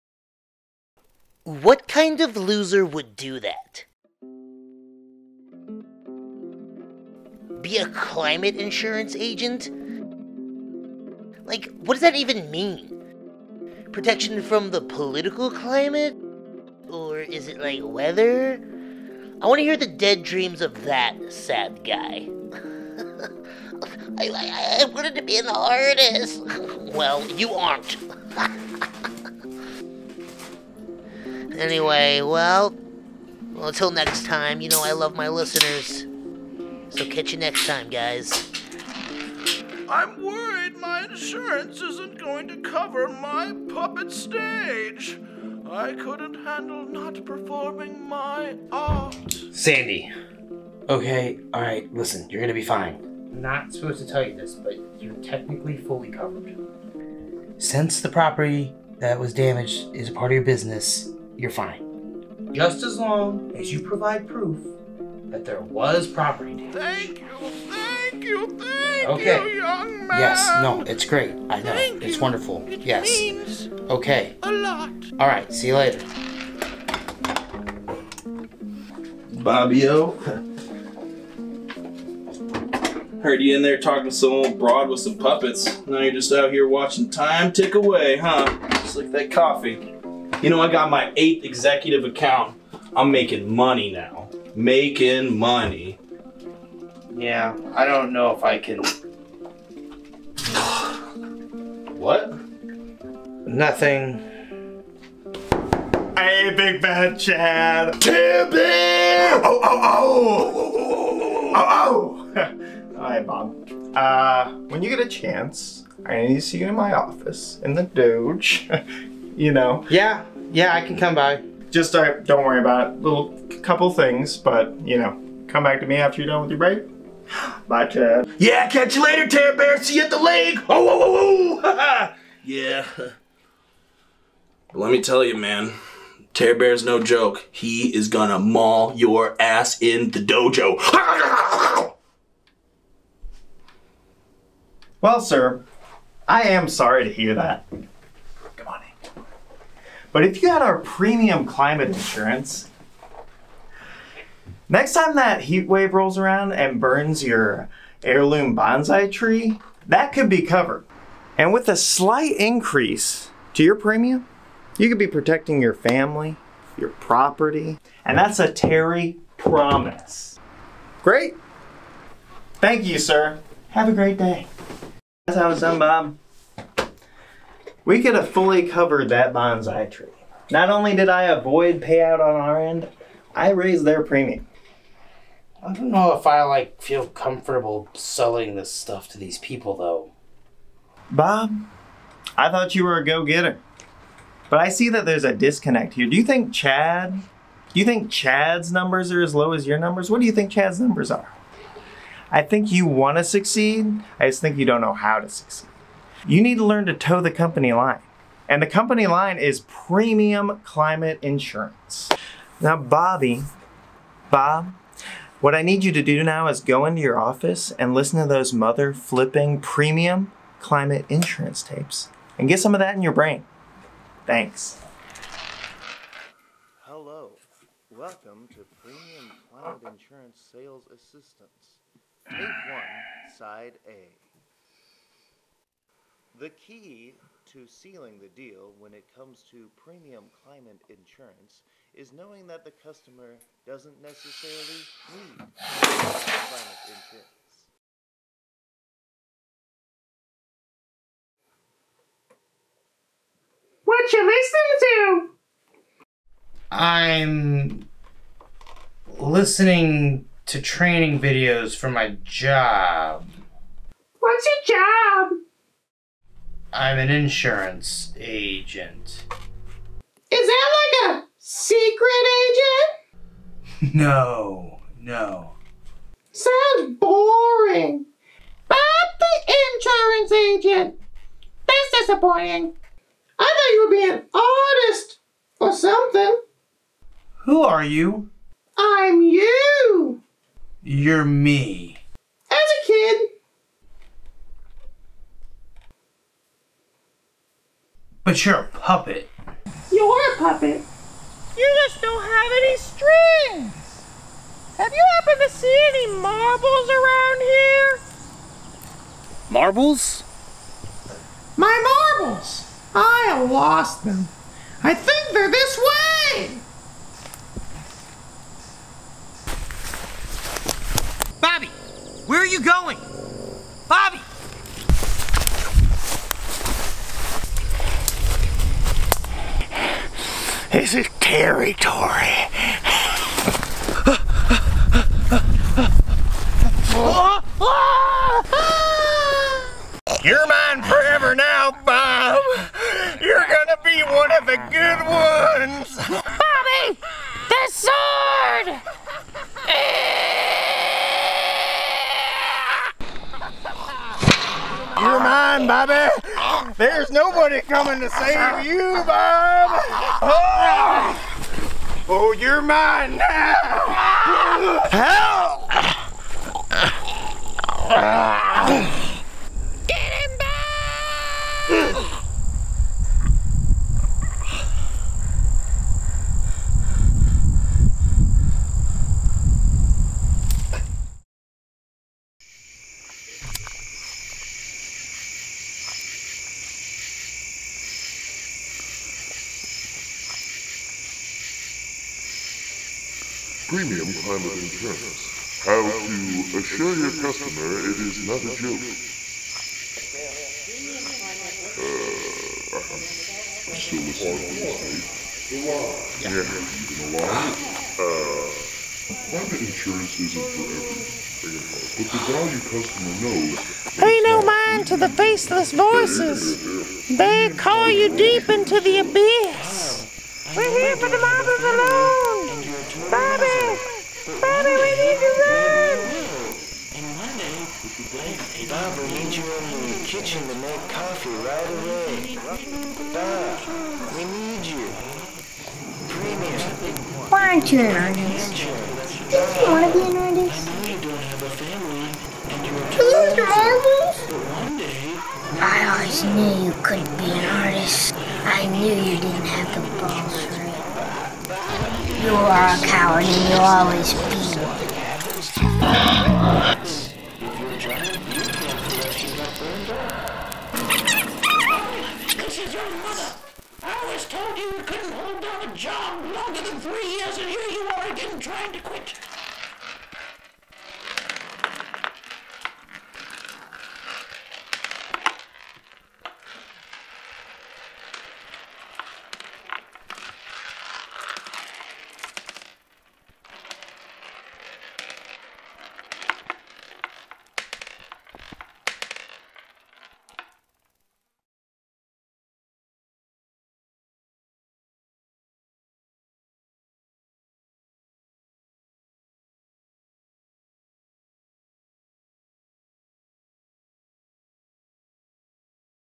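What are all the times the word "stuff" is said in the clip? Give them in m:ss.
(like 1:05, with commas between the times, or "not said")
3:08.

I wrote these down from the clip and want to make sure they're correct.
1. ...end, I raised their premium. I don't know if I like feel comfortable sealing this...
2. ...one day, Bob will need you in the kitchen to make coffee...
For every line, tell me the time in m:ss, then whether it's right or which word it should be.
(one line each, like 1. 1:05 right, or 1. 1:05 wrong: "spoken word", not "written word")
1. 3:02 wrong: "selling", not "sealing"
2. 7:07 right.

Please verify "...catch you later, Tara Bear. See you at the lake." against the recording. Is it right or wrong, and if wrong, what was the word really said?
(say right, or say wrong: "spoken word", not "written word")
right.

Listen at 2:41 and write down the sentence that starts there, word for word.
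And with a slight increase to your premium, you could be protecting your family, your property, and that's a Terry promise.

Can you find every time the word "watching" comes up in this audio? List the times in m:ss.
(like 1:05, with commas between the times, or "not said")
1:26.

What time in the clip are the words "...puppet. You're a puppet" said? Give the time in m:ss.
4:58.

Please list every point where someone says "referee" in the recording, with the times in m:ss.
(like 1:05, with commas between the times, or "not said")
not said.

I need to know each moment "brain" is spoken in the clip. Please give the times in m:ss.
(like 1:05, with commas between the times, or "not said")
3:43.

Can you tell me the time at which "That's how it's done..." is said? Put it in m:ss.
2:55.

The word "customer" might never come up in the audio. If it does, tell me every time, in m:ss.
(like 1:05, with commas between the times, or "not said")
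4:02, 6:37, 6:52.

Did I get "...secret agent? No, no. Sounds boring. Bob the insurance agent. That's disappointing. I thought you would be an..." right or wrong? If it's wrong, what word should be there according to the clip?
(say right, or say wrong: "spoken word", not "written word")
right.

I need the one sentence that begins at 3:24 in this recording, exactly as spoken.
I just think you don't know how to succeed you need to learn to tow the company line.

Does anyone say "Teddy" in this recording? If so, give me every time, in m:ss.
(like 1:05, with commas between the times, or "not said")
2:16.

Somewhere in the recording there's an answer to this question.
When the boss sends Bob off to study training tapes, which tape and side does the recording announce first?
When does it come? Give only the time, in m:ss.
3:52.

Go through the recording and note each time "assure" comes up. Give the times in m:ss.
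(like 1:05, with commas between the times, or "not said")
6:36.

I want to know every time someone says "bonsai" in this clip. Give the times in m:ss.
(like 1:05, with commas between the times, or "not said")
2:38, 2:59.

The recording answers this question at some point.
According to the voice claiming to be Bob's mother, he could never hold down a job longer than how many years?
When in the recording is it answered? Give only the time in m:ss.
7:46.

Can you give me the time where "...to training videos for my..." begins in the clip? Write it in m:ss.
4:20.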